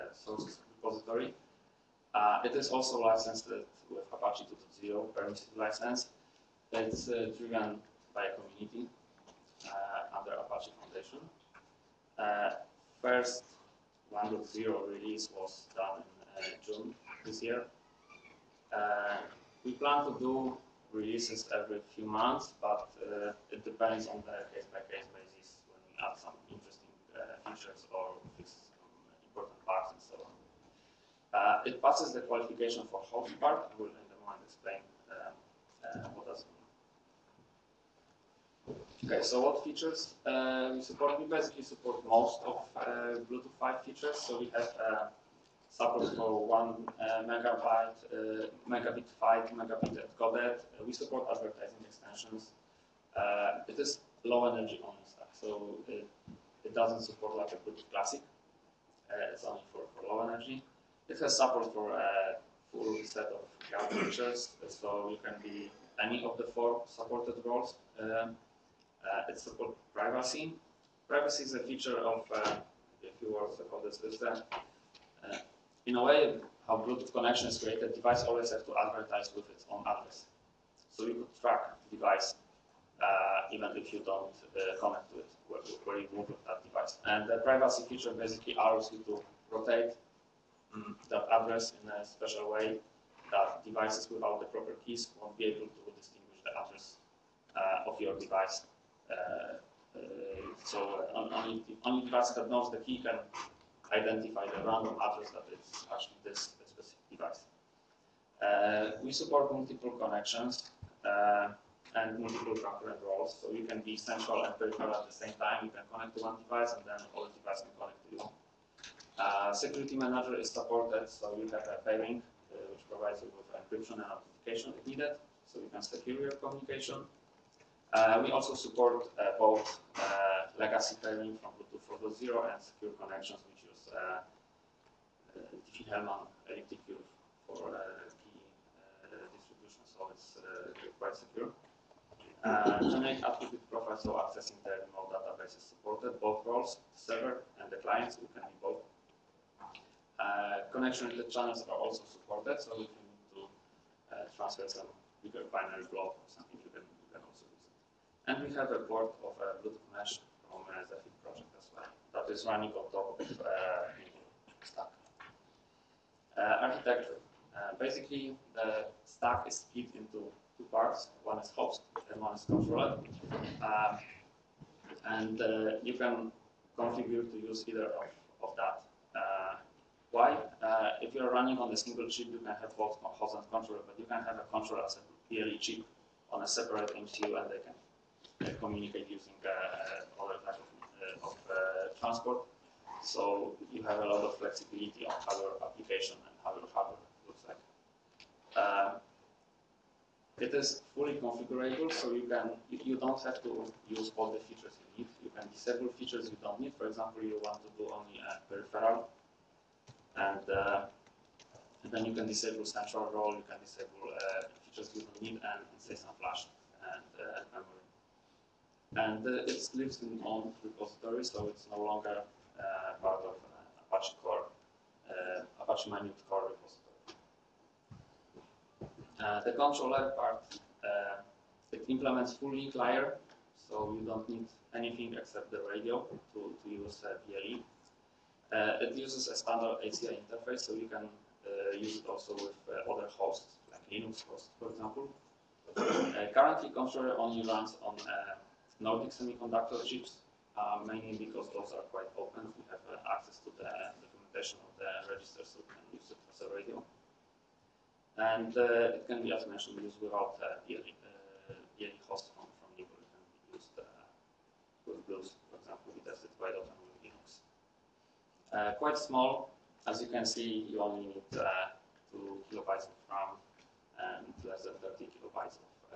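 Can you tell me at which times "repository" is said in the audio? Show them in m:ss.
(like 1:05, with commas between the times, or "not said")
0:00, 3:40, 3:46.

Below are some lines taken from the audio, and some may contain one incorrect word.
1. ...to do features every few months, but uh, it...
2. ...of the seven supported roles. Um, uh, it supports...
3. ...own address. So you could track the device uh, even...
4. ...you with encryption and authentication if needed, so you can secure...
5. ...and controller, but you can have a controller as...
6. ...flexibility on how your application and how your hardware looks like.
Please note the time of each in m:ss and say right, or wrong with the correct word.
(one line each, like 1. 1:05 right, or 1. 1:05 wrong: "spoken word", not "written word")
1. 0:20 wrong: "releases", not "features"
2. 1:06 wrong: "four", not "seven"
3. 1:19 right
4. 2:03 right
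5. 3:03 right
6. 3:14 right.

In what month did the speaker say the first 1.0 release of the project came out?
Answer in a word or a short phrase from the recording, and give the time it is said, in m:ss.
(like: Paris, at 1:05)
June, at 0:16.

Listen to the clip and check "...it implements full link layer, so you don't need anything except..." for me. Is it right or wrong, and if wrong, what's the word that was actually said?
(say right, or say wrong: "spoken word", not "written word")
right.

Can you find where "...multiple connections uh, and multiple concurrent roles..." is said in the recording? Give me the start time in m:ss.
1:49.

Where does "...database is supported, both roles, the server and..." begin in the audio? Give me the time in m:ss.
2:25.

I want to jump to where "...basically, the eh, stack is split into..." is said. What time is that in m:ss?
2:47.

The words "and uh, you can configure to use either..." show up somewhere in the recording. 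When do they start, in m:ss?
2:55.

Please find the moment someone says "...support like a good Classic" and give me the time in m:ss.
0:57.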